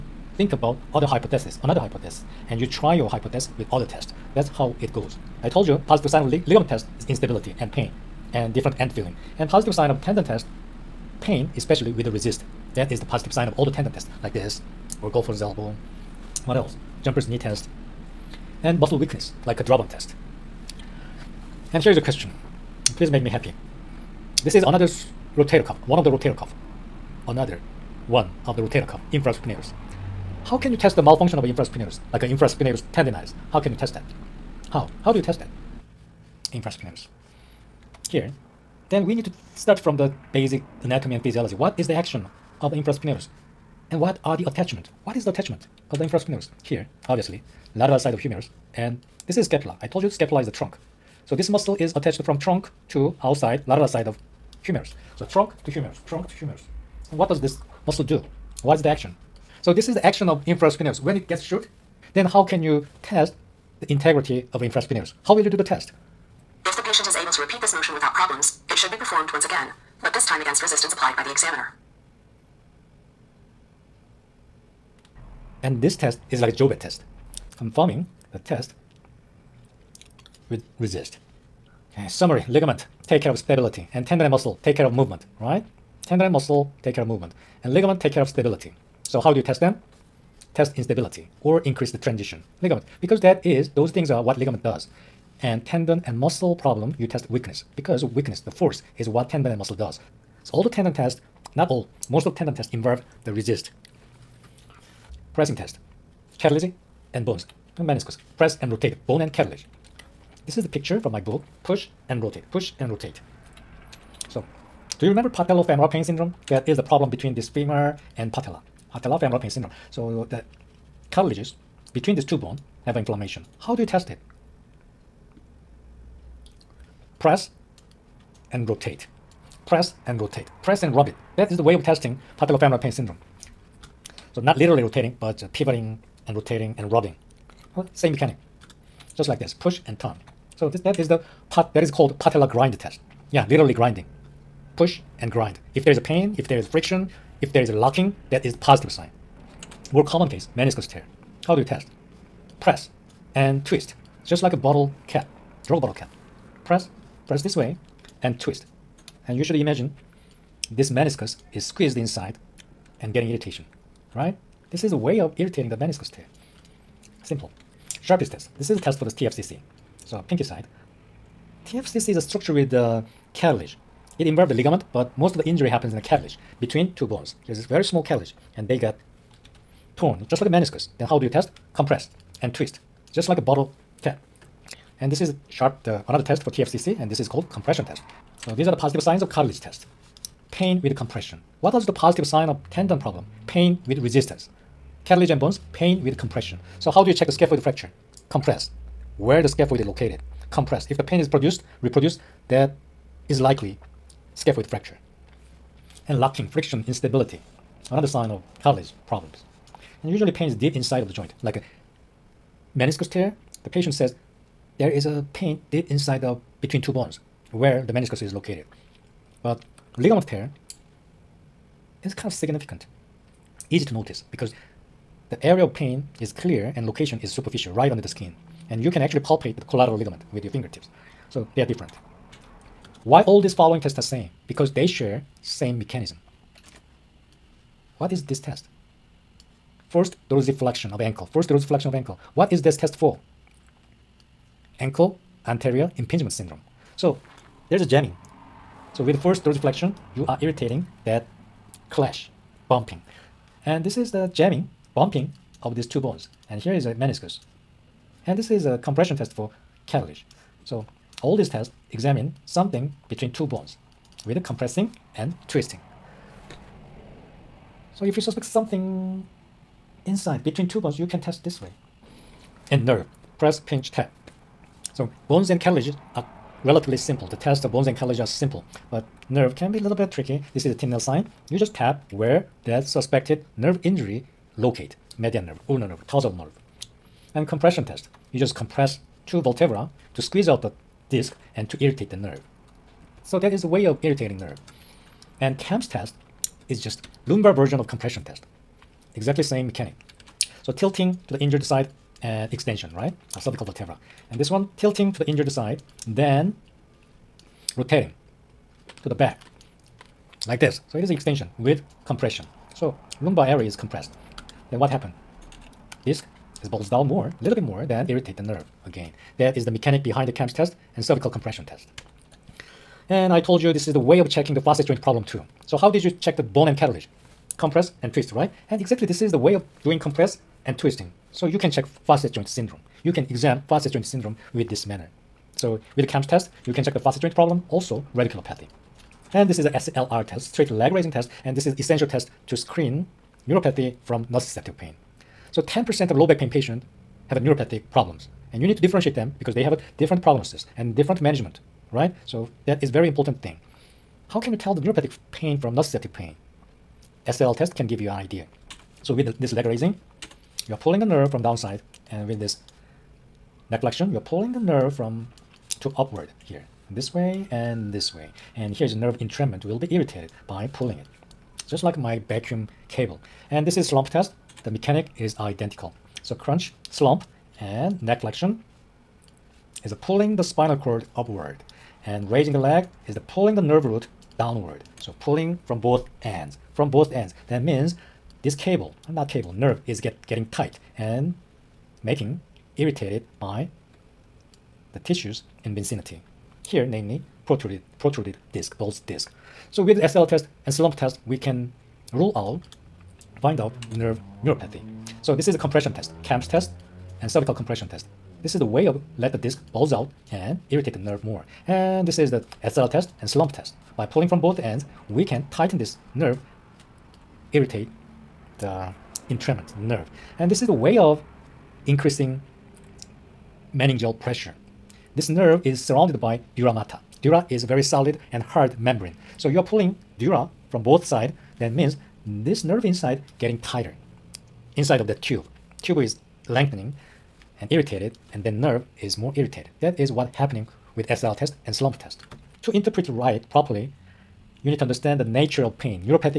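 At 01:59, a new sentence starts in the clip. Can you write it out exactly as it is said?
So the cartilages between these two bones have inflammation.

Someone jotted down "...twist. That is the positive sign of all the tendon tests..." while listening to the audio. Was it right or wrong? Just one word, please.
wrong.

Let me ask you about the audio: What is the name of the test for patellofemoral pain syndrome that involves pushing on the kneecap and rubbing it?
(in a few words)
Patella grind test.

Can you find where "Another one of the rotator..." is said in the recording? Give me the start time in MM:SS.
00:27.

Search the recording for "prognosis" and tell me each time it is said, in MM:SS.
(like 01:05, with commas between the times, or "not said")
05:50.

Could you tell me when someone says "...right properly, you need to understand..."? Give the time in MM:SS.
07:23.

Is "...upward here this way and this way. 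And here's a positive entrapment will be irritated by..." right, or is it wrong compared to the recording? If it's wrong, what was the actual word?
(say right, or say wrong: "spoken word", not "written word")
wrong: "nerve", not "positive".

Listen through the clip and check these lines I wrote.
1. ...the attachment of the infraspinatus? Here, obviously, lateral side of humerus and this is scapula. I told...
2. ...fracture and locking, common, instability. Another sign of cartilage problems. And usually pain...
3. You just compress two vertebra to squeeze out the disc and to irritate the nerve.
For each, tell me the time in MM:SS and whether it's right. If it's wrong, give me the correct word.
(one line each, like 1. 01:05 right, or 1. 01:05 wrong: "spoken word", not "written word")
1. 00:45 right
2. 03:24 wrong: "friction", not "common"
3. 04:48 right.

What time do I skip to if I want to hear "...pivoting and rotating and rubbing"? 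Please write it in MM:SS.
02:15.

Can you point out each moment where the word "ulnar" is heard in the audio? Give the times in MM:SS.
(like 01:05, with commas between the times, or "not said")
04:45.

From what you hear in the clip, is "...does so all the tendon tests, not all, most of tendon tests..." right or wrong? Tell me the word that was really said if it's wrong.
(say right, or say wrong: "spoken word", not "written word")
right.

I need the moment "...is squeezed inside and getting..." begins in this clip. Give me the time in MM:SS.
02:41.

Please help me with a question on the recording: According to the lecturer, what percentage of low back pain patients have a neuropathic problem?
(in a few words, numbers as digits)
10%.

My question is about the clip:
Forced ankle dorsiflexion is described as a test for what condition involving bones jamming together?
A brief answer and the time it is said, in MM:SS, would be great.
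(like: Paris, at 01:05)
Ankle anterior impingement syndrome, at 04:04.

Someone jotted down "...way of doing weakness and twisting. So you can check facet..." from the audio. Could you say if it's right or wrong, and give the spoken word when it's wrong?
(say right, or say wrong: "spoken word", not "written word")
wrong: "compress", not "weakness".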